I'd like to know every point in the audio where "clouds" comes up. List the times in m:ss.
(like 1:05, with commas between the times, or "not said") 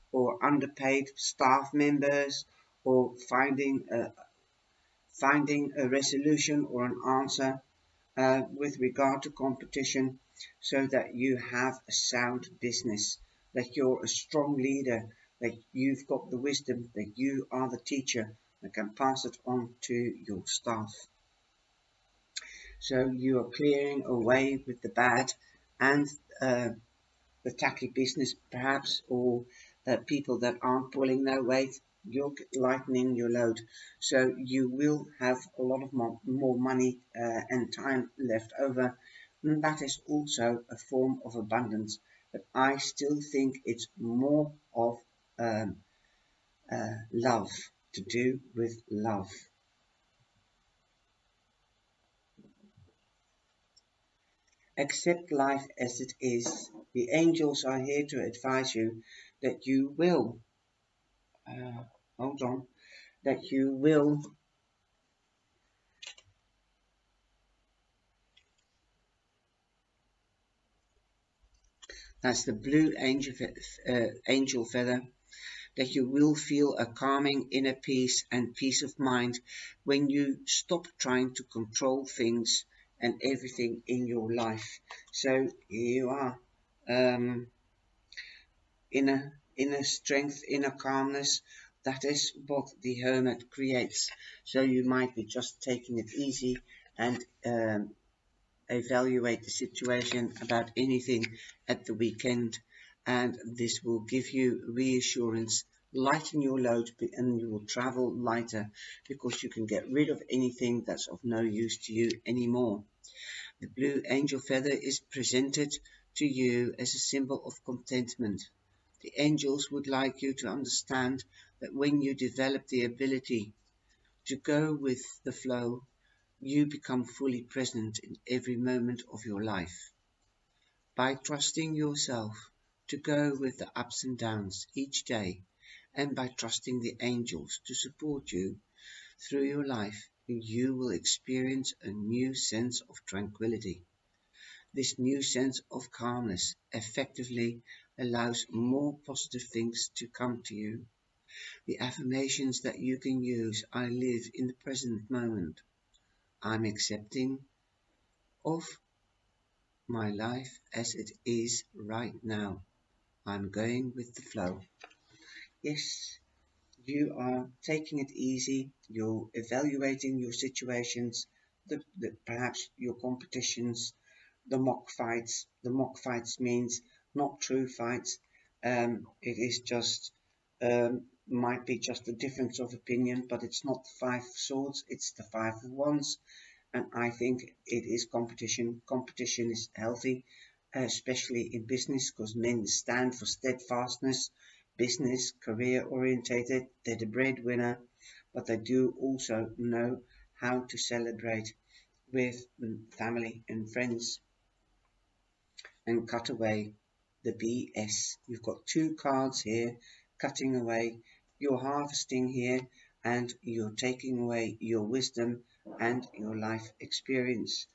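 not said.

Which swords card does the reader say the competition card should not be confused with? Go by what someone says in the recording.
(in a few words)
Five swords.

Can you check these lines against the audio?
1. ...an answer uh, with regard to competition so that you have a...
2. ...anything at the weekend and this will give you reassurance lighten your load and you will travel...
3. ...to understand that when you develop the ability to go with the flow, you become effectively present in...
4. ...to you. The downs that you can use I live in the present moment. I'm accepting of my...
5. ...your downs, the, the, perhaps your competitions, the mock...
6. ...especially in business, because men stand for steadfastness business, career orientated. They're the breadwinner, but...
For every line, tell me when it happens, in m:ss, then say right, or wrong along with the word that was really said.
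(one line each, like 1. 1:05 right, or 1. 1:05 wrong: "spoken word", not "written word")
1. 0:06 right
2. 1:40 right
3. 2:00 wrong: "fully", not "effectively"
4. 2:30 wrong: "affirmations", not "downs"
5. 2:50 wrong: "situations", not "downs"
6. 3:10 right.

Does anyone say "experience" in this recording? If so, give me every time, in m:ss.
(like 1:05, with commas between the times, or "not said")
2:20, 3:36.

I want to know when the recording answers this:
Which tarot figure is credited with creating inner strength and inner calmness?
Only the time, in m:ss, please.
1:32.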